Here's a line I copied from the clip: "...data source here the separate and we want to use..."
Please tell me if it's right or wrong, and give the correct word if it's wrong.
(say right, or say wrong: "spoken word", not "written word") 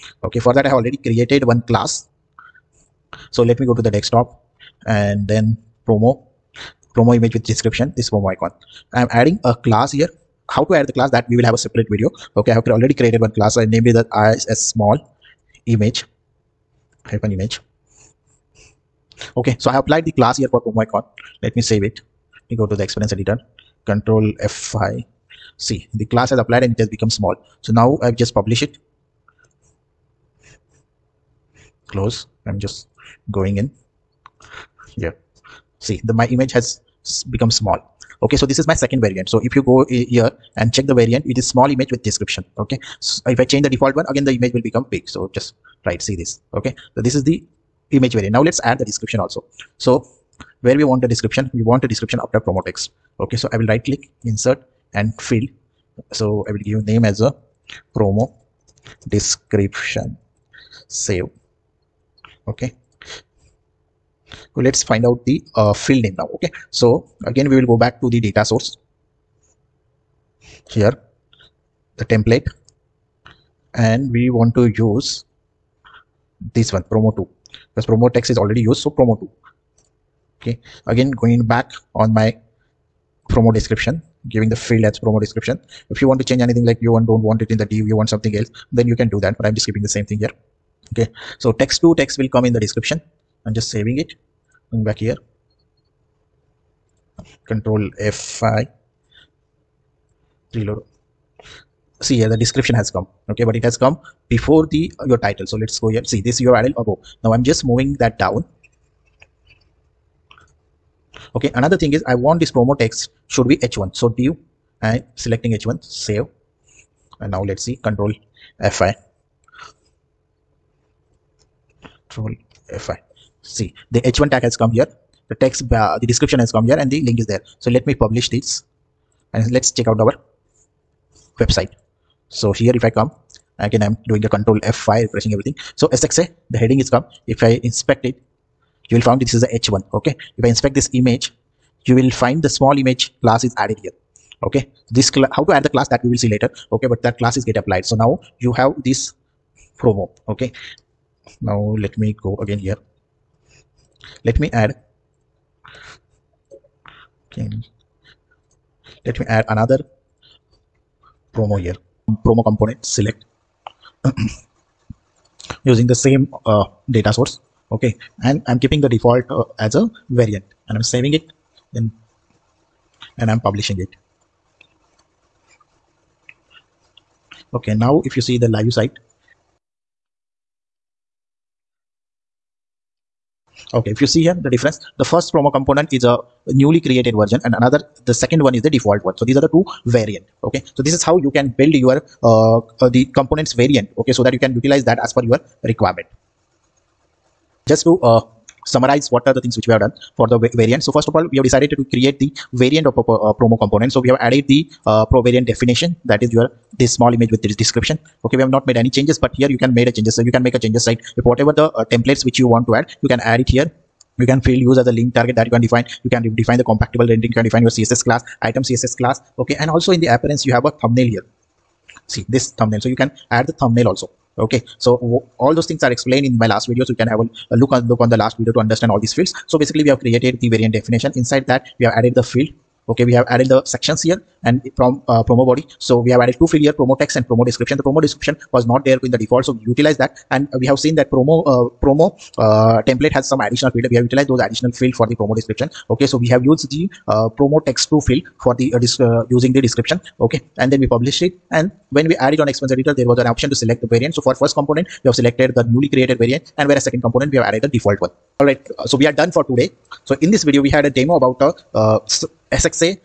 wrong: "template", not "separate".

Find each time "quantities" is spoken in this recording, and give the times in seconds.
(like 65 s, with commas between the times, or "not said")
not said.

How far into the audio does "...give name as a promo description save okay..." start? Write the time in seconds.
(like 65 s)
56 s.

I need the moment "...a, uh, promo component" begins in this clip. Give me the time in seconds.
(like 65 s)
202 s.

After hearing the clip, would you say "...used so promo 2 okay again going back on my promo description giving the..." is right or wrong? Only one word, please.
right.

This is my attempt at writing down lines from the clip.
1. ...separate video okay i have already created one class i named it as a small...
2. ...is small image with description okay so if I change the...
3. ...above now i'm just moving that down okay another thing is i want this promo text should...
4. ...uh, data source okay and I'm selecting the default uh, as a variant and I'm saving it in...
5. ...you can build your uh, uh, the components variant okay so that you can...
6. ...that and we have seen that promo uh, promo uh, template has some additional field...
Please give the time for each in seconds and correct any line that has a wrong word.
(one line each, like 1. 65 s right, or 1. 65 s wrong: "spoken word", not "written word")
1. 11 s right
2. 41 s right
3. 106 s right
4. 166 s wrong: "keeping", not "selecting"
5. 191 s right
6. 239 s right.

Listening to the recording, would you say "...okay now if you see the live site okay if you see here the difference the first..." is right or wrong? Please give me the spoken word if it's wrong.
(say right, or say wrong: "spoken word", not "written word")
right.